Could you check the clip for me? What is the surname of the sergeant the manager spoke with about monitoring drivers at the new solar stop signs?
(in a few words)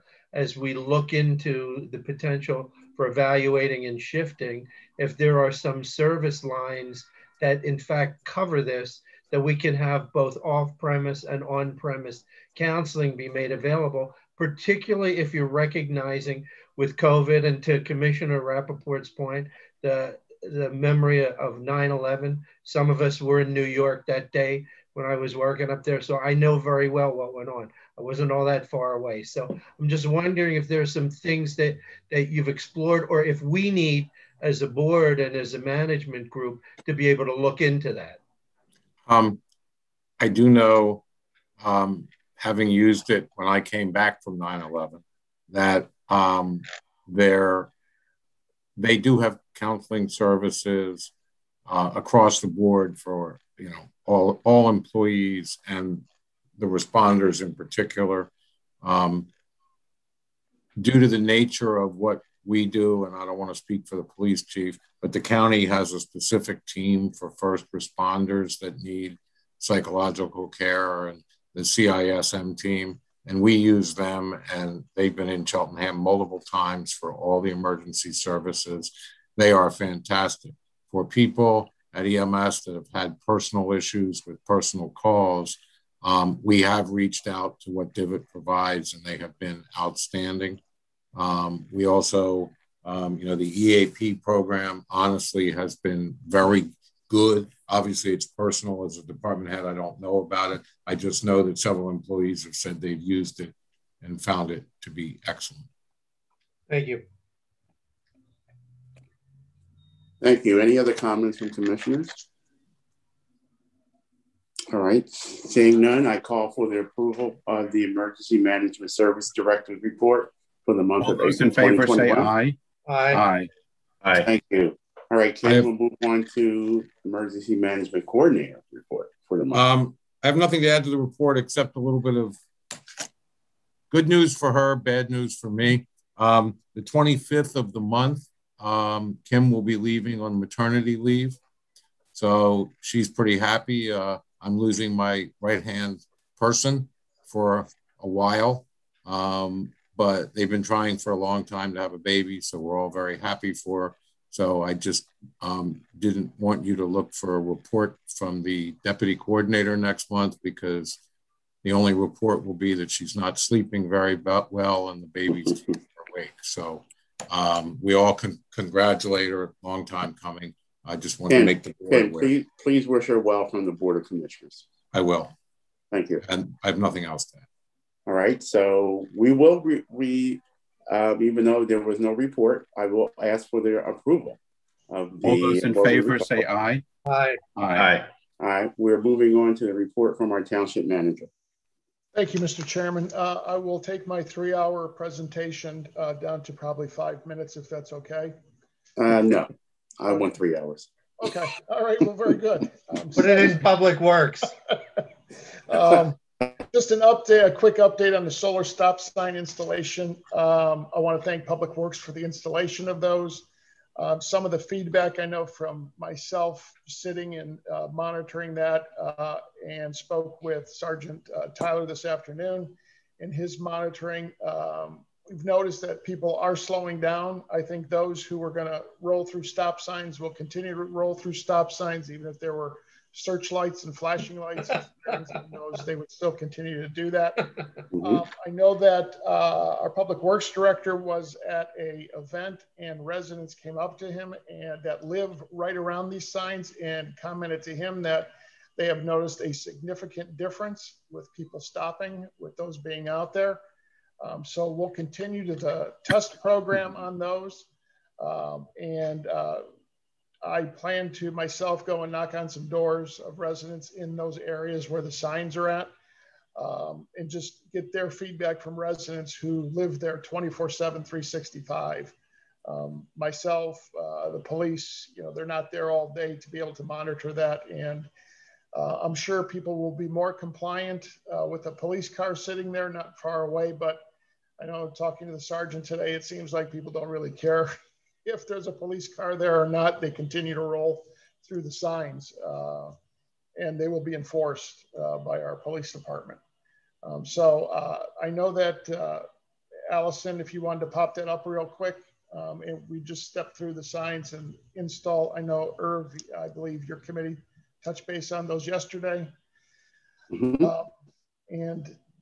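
Tyler.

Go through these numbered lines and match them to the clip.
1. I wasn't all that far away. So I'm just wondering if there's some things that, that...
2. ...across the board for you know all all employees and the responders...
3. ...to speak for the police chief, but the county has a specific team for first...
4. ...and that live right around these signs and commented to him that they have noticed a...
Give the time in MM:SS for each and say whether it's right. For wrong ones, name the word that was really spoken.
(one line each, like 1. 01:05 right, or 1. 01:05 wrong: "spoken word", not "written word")
1. 00:27 right
2. 00:51 right
3. 01:03 right
4. 04:04 right.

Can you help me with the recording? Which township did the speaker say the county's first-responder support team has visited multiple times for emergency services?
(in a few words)
Cheltenham.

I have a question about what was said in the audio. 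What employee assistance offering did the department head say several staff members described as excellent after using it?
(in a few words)
EAP program.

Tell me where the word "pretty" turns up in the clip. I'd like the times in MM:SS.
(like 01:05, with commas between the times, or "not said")
02:23.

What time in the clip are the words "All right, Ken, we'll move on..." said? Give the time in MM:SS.
02:05.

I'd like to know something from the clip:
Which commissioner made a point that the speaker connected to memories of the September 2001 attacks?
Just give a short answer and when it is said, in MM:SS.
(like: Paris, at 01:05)
Rappoport, at 00:18.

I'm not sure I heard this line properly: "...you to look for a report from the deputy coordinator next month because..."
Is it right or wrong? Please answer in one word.
right.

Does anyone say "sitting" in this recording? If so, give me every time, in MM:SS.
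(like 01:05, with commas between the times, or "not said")
03:36, 04:42.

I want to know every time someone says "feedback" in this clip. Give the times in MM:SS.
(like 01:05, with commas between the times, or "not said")
03:34, 04:28.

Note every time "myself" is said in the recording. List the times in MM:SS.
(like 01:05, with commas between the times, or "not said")
03:35, 04:21, 04:33.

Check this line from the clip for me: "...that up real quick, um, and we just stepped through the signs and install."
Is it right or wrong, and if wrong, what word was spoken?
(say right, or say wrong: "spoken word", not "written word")
right.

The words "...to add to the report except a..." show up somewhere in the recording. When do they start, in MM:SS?
02:10.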